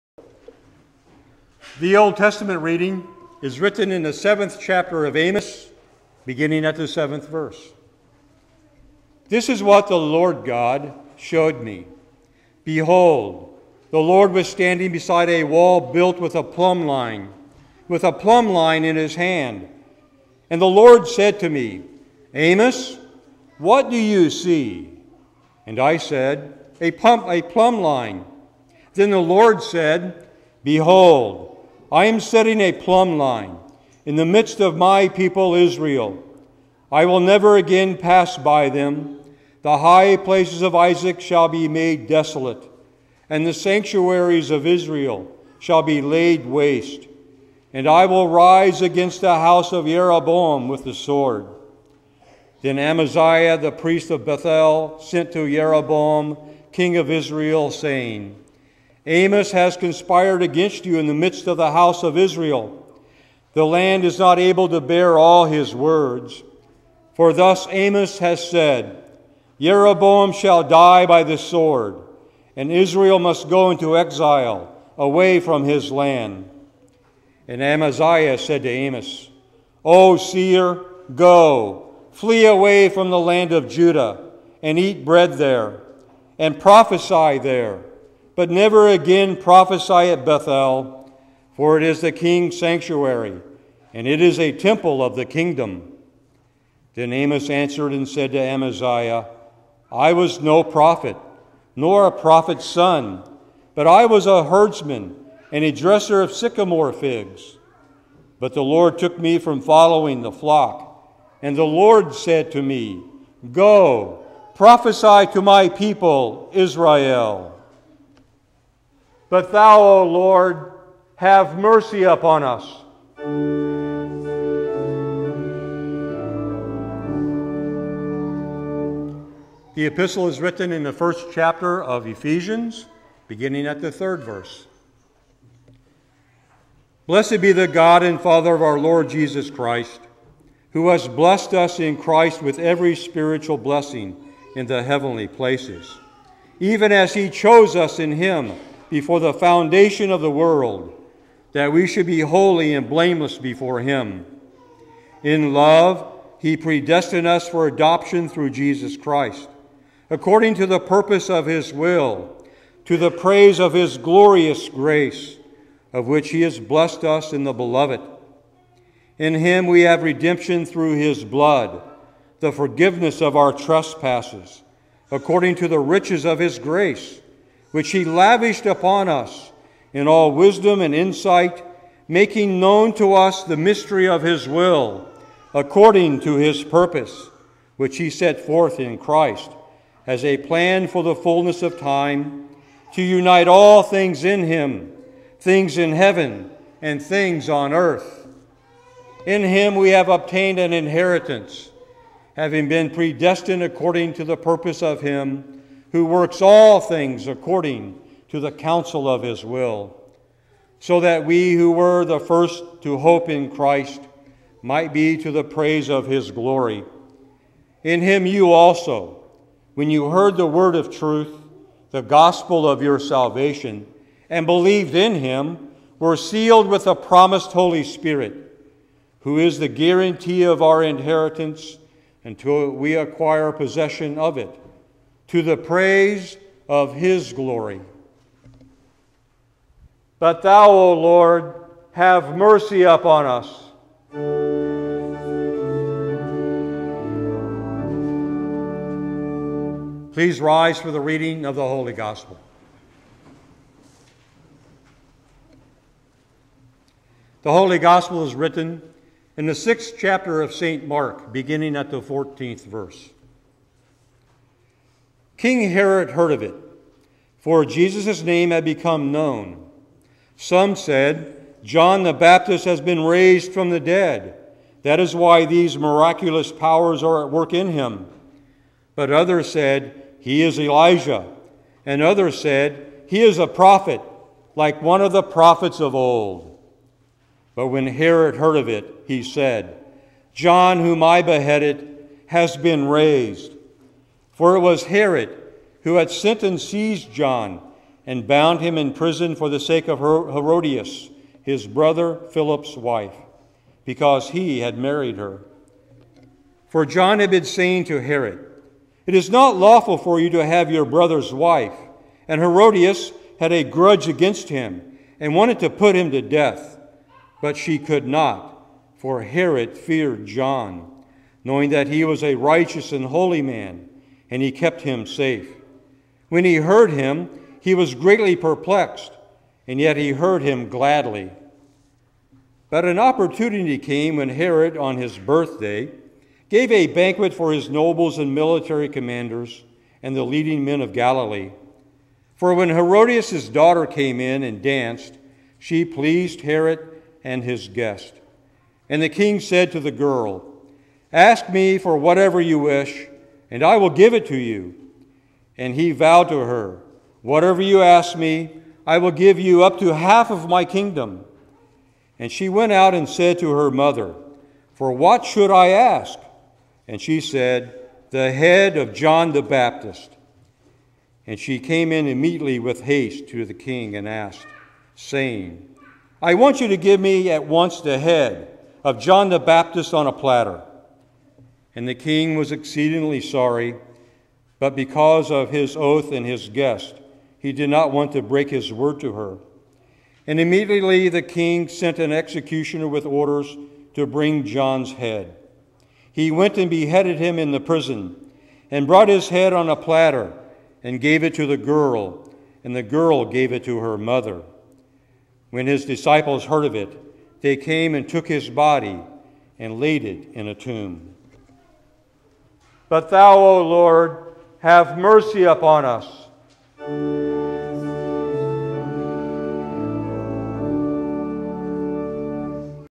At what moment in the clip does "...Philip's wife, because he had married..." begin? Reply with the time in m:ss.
5:02.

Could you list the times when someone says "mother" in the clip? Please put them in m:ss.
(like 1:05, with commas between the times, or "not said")
6:03, 6:43.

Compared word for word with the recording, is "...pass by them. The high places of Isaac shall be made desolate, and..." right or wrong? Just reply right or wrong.
right.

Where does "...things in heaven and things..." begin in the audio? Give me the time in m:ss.
3:15.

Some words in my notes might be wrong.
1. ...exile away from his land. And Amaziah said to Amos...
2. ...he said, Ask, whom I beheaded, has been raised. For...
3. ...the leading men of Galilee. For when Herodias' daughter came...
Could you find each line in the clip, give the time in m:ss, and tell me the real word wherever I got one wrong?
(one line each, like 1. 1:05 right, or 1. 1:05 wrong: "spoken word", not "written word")
1. 1:13 right
2. 4:49 wrong: "John", not "Ask"
3. 5:40 right.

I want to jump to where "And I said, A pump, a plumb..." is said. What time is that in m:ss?
0:25.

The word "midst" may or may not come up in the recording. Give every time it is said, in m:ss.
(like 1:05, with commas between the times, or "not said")
0:34, 1:01.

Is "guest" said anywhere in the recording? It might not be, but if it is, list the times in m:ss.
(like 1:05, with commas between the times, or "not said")
5:47, 6:26.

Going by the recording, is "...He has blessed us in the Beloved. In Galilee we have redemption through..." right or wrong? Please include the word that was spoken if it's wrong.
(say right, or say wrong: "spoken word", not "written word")
wrong: "Him", not "Galilee".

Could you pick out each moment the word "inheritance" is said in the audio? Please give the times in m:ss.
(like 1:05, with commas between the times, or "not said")
3:20, 3:50.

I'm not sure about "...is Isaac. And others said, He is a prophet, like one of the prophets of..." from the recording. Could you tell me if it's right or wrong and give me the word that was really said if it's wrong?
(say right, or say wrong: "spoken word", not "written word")
wrong: "Elijah", not "Isaac".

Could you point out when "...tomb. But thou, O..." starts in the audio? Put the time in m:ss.
6:50.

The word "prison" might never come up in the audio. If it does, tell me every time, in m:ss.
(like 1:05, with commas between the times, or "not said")
4:58, 6:37.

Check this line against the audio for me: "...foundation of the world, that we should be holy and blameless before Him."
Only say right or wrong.
right.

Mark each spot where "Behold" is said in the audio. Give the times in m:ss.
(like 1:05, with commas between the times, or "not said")
0:12, 0:30.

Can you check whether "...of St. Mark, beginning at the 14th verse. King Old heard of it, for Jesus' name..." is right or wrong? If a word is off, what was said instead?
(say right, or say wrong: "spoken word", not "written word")
wrong: "Herod", not "Old".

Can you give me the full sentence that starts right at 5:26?
When he heard him, he was greatly perplexed, and yet he heard him gladly.